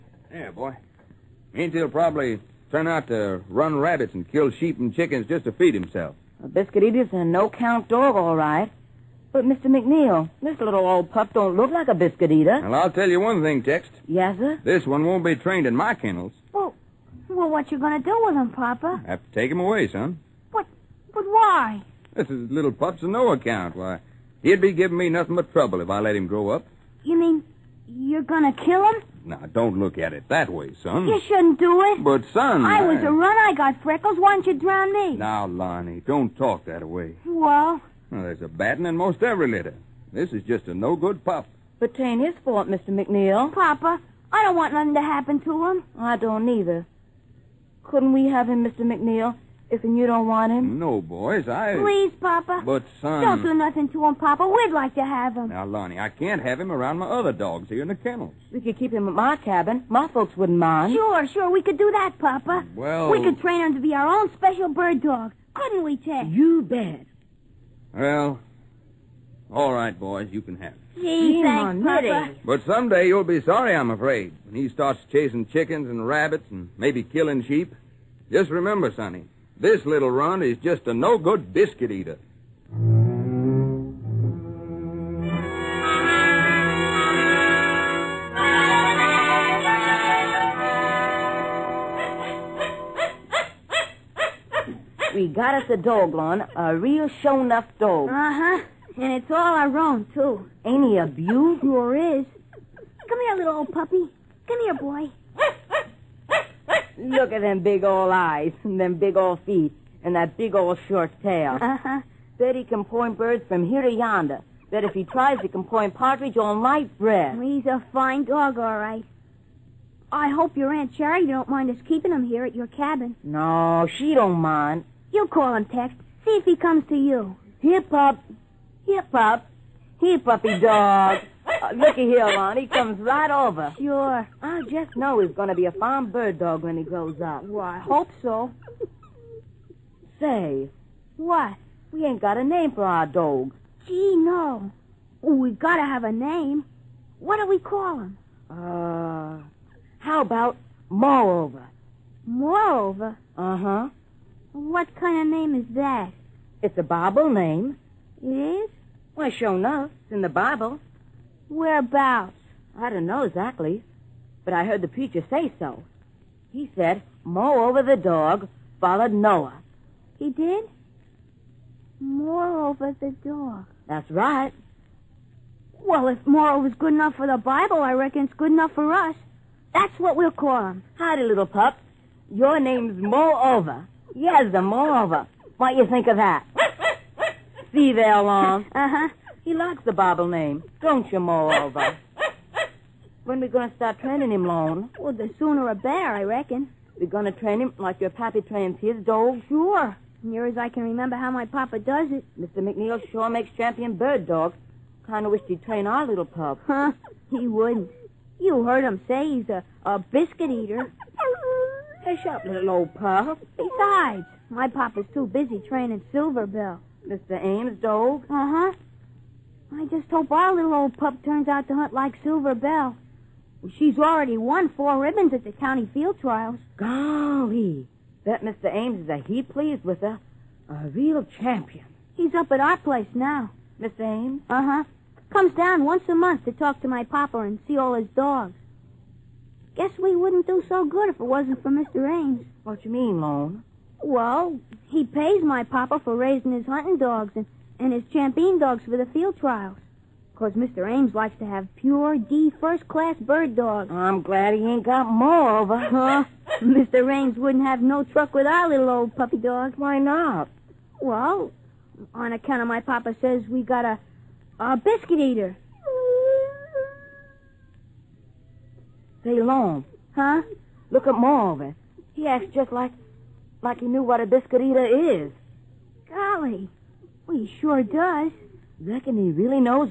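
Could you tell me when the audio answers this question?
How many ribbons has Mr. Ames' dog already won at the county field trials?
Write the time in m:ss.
3:44.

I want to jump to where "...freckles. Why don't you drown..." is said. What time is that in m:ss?
0:33.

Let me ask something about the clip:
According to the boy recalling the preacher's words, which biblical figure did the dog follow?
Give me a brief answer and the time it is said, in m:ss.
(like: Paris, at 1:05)
Noah, at 2:49.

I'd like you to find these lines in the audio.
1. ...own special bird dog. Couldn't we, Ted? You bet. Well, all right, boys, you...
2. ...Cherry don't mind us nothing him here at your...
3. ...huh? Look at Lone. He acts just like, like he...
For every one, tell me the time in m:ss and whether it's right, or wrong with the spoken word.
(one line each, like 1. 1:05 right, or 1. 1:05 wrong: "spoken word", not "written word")
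1. 1:04 right
2. 2:00 wrong: "keeping", not "nothing"
3. 4:30 wrong: "Marvin", not "Lone".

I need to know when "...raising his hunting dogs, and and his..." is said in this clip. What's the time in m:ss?
4:06.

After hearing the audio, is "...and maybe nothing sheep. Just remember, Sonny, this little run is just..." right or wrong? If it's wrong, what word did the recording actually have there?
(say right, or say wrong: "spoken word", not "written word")
wrong: "killing", not "nothing".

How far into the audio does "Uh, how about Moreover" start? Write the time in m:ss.
2:28.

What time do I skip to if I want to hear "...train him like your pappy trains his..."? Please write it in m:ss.
3:17.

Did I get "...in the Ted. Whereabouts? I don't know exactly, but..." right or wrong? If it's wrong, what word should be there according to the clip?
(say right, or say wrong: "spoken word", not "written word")
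wrong: "Bible", not "Ted".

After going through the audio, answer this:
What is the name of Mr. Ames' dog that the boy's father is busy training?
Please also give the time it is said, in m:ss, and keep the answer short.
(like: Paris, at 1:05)
Silverbell, at 3:36.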